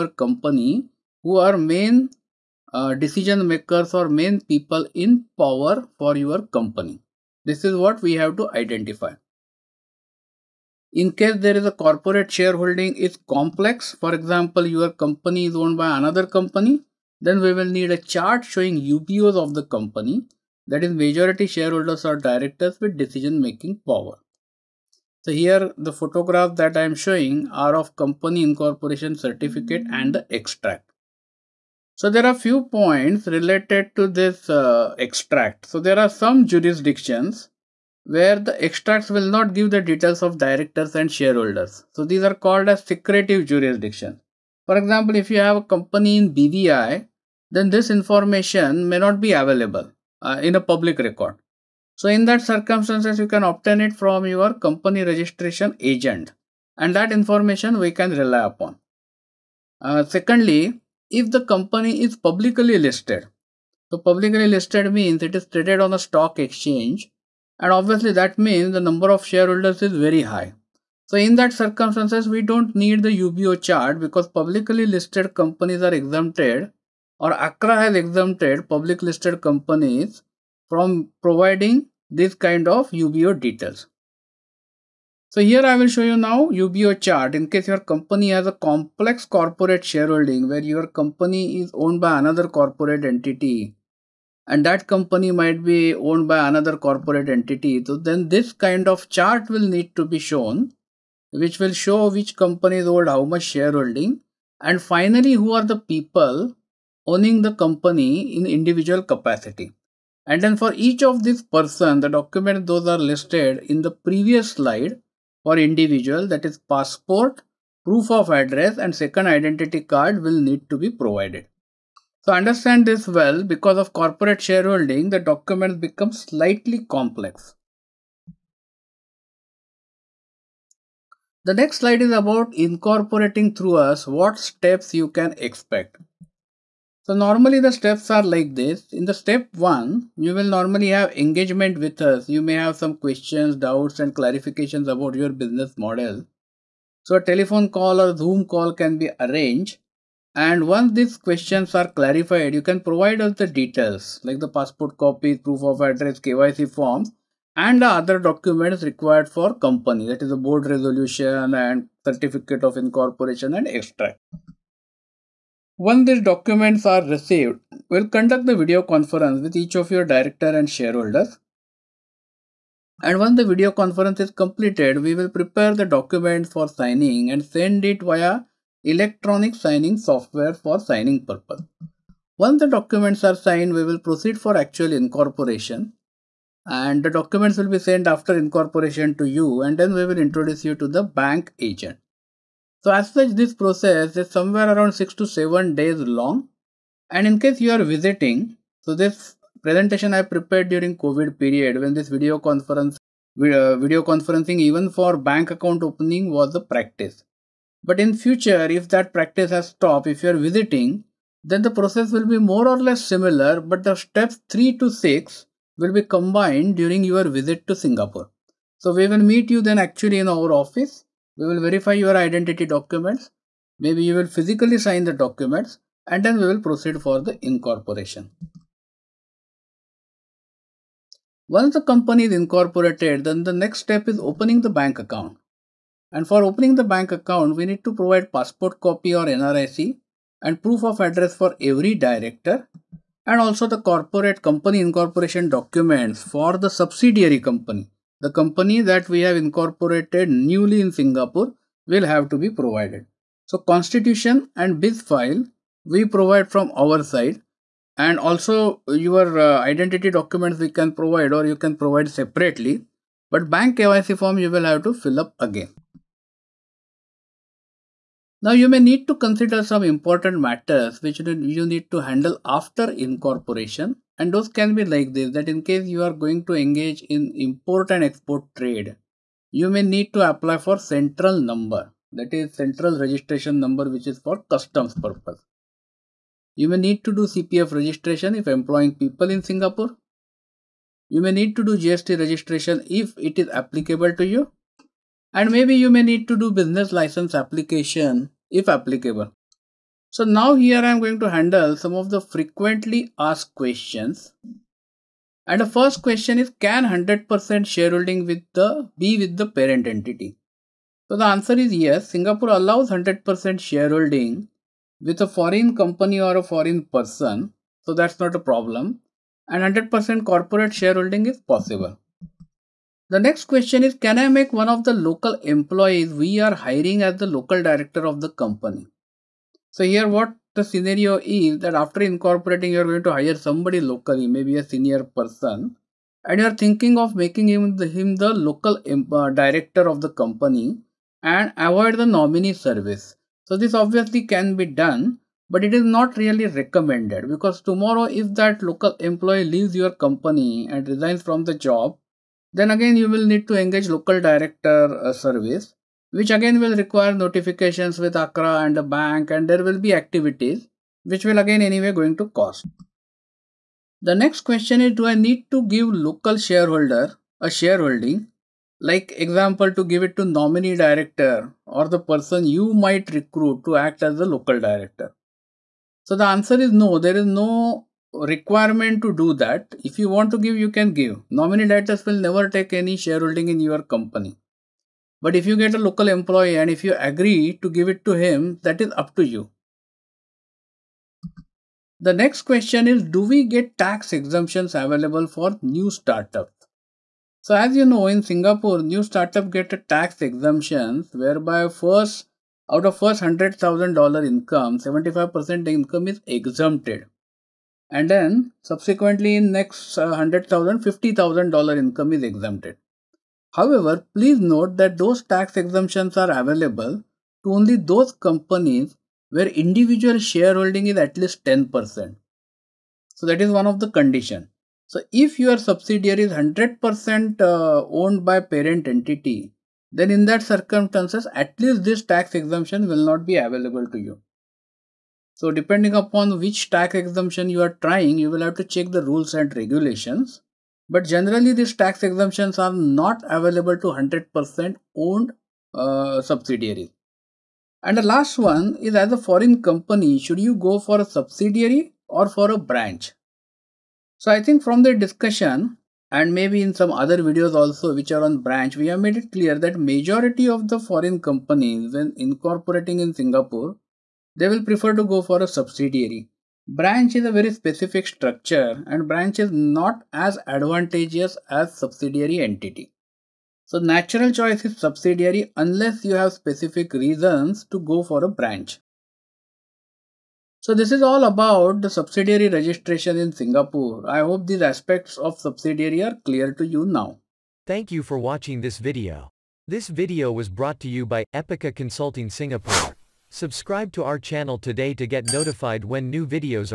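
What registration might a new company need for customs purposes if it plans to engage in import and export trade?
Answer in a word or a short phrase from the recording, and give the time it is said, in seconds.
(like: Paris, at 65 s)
central registration number, at 282 s.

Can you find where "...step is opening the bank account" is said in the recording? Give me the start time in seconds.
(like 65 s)
233 s.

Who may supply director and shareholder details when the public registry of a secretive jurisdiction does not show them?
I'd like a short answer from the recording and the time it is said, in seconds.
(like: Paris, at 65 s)
company registration agent, at 54 s.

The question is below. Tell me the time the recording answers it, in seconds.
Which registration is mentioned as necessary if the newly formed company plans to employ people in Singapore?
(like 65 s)
287 s.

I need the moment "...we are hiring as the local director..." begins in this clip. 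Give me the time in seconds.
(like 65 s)
326 s.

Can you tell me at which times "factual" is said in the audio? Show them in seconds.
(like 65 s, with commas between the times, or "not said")
not said.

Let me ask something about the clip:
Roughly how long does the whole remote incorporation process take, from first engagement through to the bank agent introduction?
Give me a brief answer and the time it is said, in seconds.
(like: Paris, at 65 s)
6 to 7 days, at 194 s.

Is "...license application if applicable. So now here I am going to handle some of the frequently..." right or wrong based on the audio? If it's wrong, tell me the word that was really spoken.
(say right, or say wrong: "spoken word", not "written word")
right.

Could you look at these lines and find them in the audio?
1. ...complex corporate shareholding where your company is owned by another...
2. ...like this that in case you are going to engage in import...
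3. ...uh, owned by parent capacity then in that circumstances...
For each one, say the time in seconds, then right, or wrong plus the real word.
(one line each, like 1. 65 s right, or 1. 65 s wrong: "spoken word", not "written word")
1. 88 s right
2. 274 s right
3. 427 s wrong: "entity", not "capacity".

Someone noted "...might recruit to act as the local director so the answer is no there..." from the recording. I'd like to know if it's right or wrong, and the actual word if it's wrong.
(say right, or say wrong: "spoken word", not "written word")
right.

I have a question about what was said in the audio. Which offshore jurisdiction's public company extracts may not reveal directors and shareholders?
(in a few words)
BVI.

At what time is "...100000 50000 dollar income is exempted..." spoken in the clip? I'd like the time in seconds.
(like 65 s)
410 s.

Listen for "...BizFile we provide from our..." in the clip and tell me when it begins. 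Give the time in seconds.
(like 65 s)
254 s.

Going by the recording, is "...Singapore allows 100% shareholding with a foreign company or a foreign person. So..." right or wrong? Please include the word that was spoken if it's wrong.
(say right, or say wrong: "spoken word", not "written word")
right.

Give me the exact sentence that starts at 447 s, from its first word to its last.
And the last one is as a foreign company, should you go for a subsidiary or for a branch?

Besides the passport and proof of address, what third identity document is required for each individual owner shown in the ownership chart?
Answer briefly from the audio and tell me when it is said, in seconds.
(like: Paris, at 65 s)
second identity card, at 119 s.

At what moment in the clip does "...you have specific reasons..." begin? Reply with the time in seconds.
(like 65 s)
476 s.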